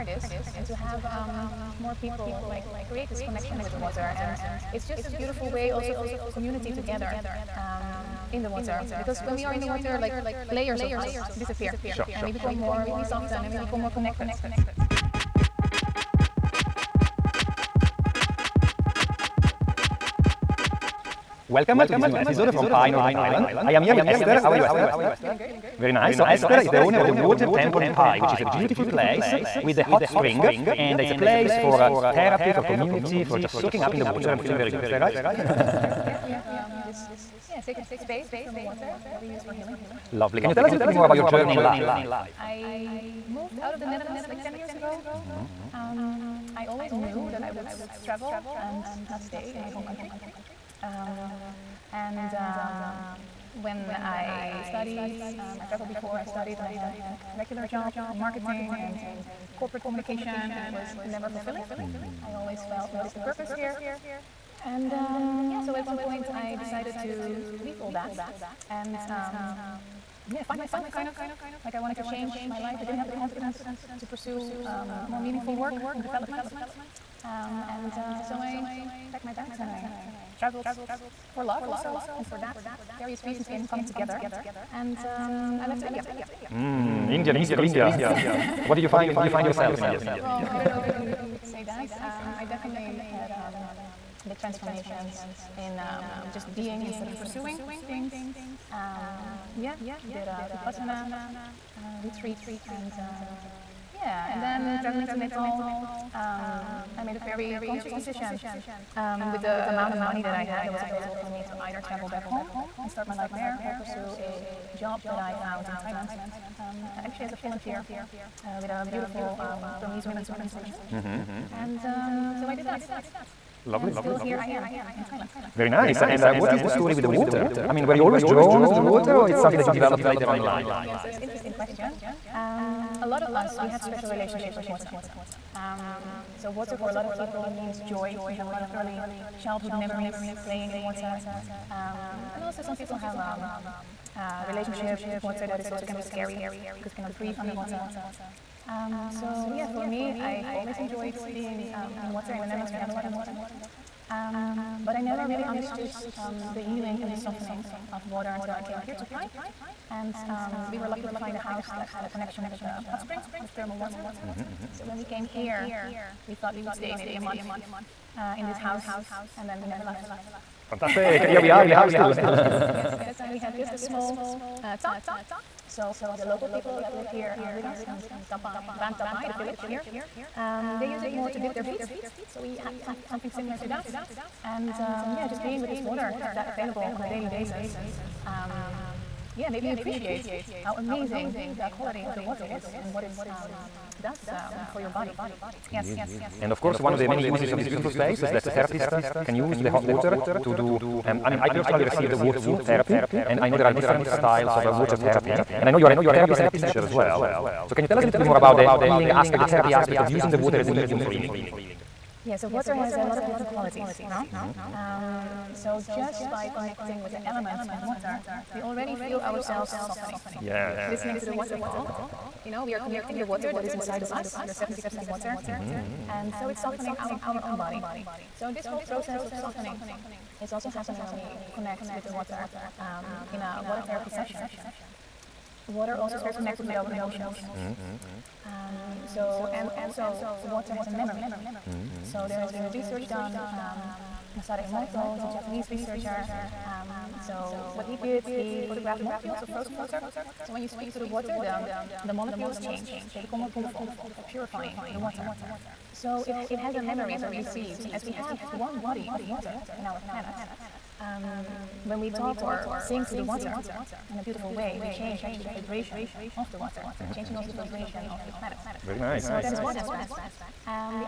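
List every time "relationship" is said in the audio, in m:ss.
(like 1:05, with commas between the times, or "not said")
2:14, 2:24.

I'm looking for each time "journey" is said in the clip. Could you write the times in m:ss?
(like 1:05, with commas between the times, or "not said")
0:41.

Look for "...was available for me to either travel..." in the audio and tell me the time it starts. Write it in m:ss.
1:50.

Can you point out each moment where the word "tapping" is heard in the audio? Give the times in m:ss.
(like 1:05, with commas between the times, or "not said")
not said.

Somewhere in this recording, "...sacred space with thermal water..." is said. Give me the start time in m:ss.
0:37.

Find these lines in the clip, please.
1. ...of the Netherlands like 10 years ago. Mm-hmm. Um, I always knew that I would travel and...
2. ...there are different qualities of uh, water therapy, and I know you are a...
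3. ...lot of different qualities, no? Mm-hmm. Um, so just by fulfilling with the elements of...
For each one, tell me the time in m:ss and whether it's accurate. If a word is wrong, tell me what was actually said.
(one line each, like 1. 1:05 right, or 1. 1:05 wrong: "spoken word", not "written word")
1. 0:43 right
2. 3:23 wrong: "styles", not "qualities"
3. 3:33 wrong: "connecting", not "fulfilling".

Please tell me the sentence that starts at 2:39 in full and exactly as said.
And um, we were lucky to find a house that had a connection with the hot spring, with thermal water.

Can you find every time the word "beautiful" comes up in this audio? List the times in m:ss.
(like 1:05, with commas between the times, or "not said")
0:05, 0:28, 1:58, 3:17, 4:13, 4:24.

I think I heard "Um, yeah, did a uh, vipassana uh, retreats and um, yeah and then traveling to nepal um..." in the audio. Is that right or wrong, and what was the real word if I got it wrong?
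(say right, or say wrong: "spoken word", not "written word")
right.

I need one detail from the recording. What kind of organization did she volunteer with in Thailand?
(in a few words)
Burmese women's organization.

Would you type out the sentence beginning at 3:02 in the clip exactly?
So we had some, something similar to that.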